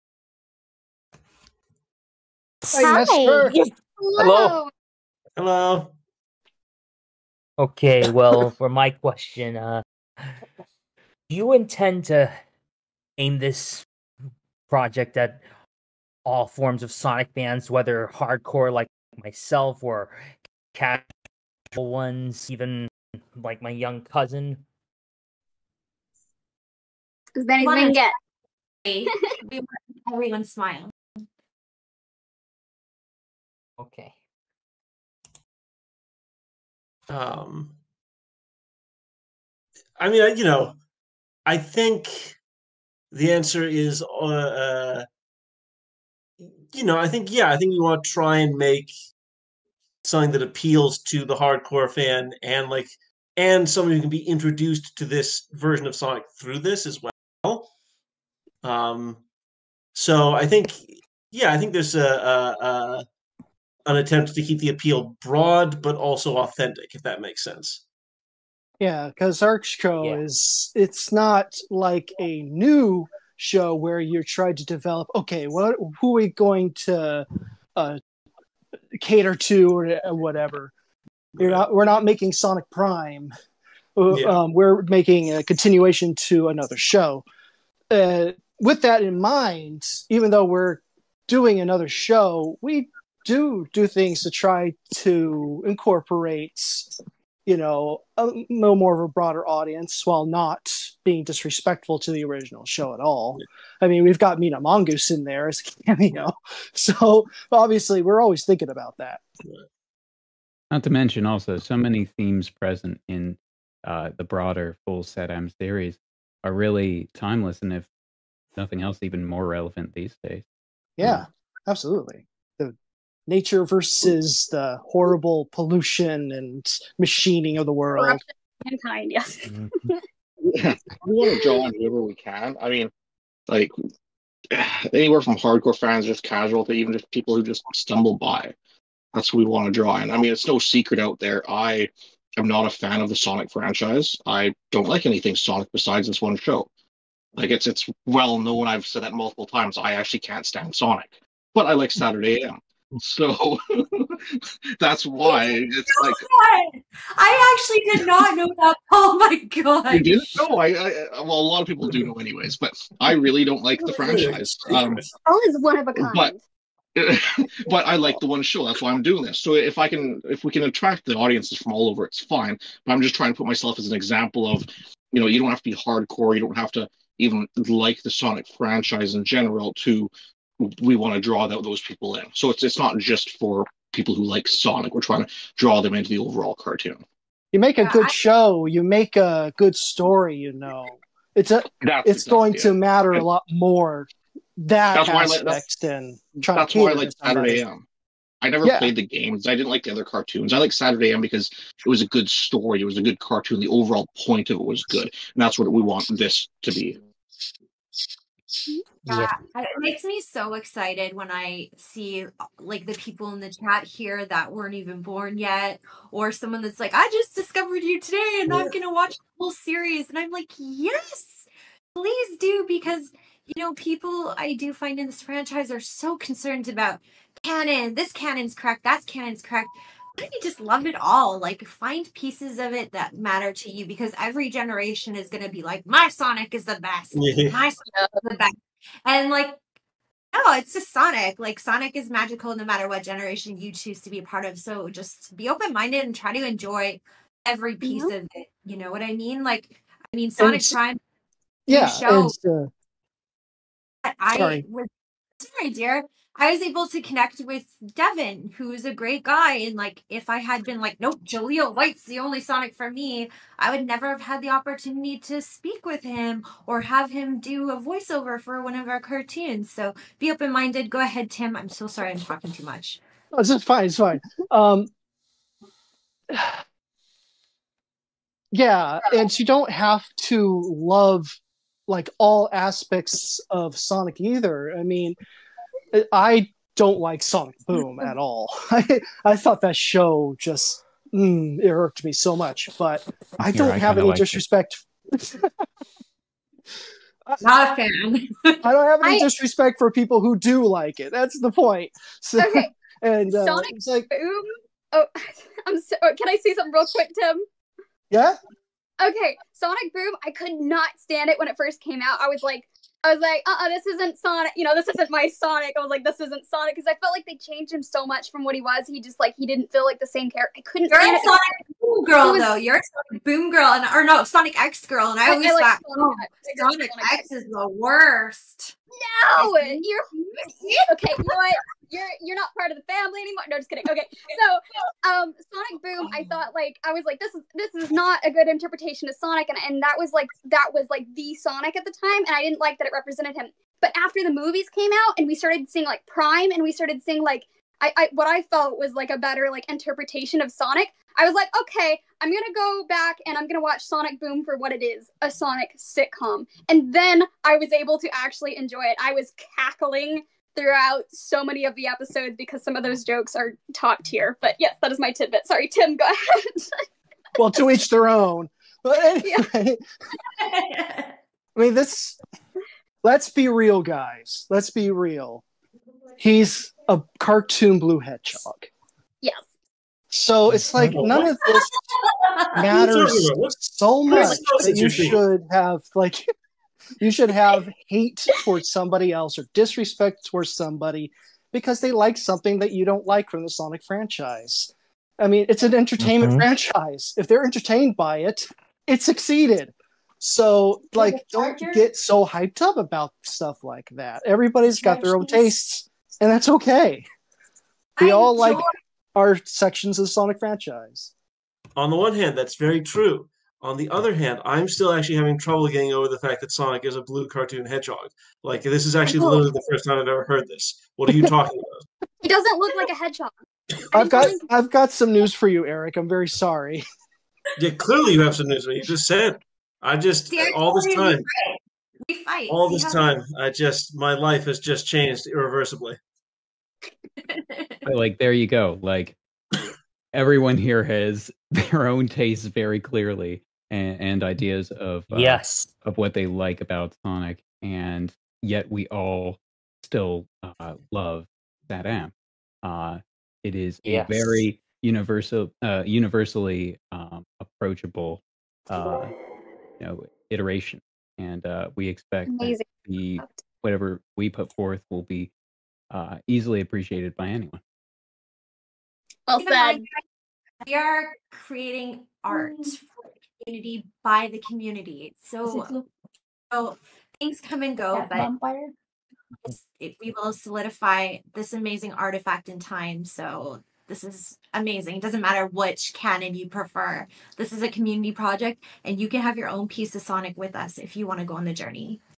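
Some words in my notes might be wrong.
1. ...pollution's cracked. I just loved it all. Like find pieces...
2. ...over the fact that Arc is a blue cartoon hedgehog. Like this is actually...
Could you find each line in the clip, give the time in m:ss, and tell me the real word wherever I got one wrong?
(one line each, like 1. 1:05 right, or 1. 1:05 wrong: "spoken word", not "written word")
1. 3:49 wrong: "canon", not "pollution"
2. 6:55 wrong: "Sonic", not "Arc".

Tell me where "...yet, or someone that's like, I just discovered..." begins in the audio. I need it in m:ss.
3:35.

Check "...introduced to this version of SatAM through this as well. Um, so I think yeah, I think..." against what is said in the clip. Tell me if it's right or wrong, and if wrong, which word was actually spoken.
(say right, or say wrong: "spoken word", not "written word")
wrong: "Sonic", not "SatAM".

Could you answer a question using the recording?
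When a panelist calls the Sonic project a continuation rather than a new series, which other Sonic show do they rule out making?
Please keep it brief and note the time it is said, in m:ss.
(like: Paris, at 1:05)
Sonic Prime, at 1:21.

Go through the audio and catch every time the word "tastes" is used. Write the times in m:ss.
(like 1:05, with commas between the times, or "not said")
6:45, 7:22.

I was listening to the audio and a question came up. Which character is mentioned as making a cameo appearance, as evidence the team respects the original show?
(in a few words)
Mina Mongoose.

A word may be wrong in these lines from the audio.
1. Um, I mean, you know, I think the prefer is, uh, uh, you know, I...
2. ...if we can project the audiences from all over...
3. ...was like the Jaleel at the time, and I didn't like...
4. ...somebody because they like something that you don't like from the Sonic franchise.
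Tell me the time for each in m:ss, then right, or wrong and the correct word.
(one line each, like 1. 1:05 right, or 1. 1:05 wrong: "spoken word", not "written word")
1. 0:37 wrong: "answer", not "prefer"
2. 2:50 wrong: "attract", not "project"
3. 5:40 wrong: "Sonic", not "Jaleel"
4. 6:30 right.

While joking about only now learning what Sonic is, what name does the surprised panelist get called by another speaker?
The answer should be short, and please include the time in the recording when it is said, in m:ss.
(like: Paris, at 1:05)
Eric, at 7:05.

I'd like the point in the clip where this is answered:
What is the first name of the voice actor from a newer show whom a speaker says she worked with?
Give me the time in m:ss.
4:17.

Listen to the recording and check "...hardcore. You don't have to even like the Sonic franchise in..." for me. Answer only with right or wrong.
right.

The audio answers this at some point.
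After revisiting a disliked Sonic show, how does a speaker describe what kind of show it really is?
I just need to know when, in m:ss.
5:55.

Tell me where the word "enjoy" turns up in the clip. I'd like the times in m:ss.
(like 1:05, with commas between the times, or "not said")
4:06, 5:58, 6:48.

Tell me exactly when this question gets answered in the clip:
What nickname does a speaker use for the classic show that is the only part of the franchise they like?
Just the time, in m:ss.
2:31.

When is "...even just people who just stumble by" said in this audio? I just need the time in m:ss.
2:16.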